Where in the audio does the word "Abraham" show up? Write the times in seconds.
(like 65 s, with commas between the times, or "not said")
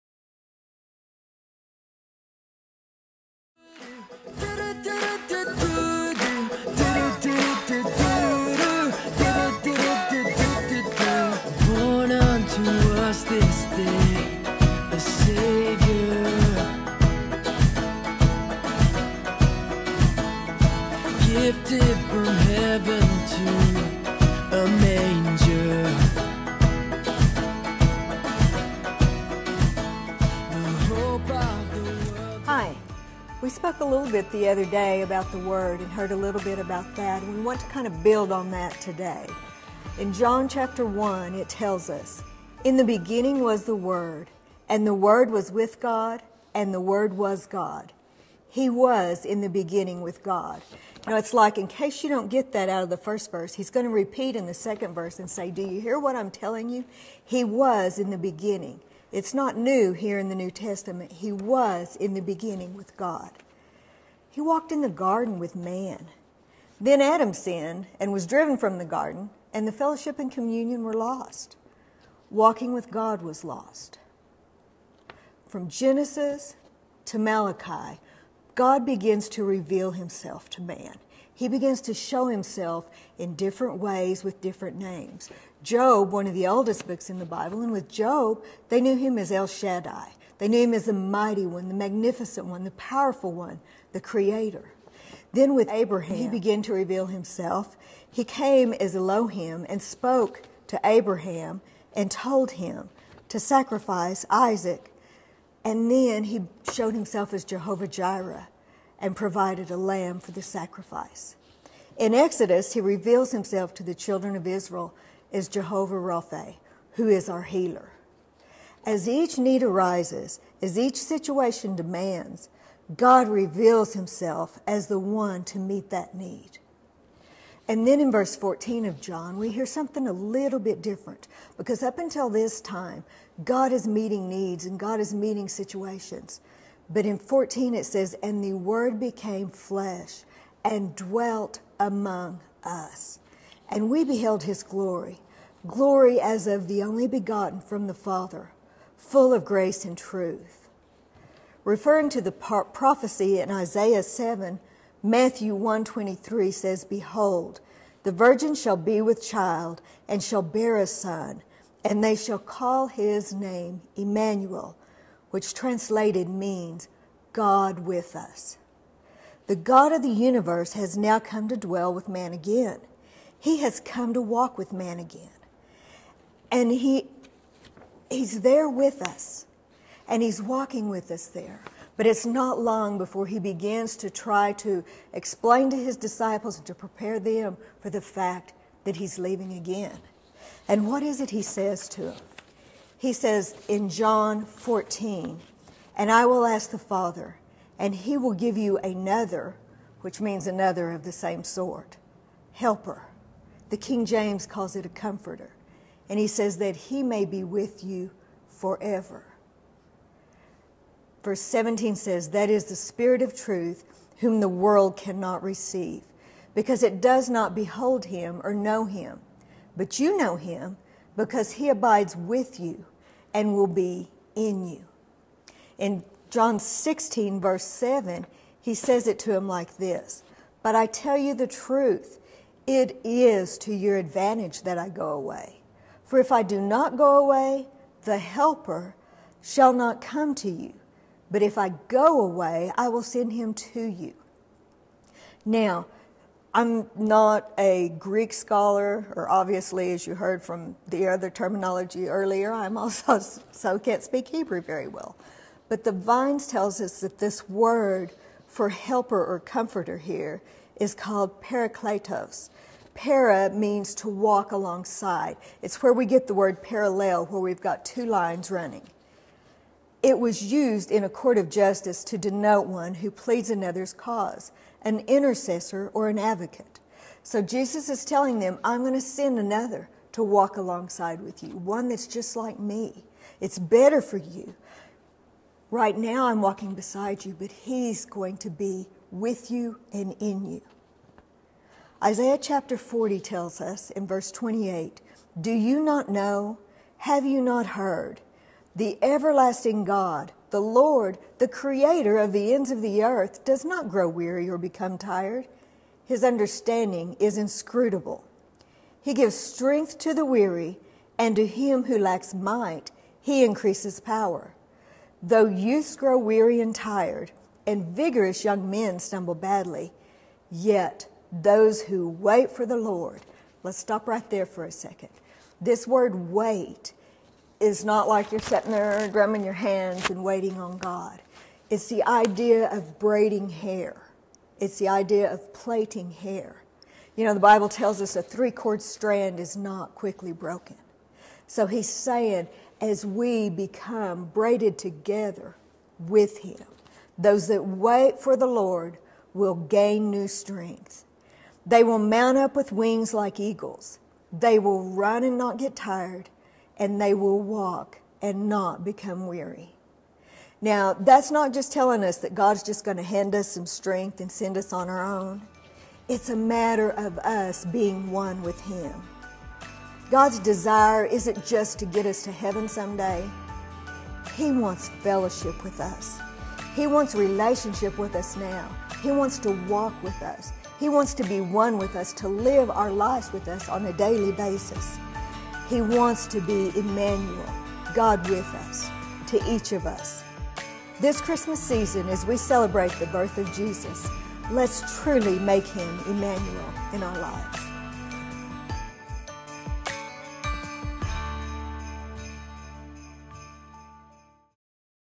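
95 s, 100 s.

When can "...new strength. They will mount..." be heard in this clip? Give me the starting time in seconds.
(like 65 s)
350 s.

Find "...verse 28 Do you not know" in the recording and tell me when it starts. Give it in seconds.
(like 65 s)
294 s.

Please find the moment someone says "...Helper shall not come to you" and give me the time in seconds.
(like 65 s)
238 s.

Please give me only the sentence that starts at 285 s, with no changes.
Right now, I'm walking beside you, but He's going to be with you and in you.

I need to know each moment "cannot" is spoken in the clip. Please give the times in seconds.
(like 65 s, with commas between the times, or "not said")
214 s.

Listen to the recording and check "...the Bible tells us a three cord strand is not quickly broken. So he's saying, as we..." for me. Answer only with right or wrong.
right.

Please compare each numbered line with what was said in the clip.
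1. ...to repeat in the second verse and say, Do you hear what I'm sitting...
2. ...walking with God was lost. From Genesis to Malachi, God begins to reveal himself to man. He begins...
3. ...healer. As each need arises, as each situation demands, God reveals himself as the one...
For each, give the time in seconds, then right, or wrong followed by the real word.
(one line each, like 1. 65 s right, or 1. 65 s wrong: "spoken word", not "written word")
1. 53 s wrong: "telling", not "sitting"
2. 72 s right
3. 117 s right.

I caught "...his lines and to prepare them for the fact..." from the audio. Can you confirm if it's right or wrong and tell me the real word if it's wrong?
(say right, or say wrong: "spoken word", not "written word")
wrong: "disciples", not "lines".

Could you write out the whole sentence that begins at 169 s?
The God of the universe has now come to dwell with man again.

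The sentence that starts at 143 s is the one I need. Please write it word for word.
And we beheld his glory, glory as of the only begotten from the Father, full of grace and truth.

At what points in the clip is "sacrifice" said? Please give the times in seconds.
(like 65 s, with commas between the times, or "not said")
103 s, 110 s.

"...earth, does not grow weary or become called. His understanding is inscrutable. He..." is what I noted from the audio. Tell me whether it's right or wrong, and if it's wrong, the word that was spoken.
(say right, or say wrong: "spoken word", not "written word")
wrong: "tired", not "called".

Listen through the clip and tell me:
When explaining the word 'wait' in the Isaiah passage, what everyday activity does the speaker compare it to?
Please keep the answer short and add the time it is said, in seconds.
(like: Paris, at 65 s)
braiding hair, at 332 s.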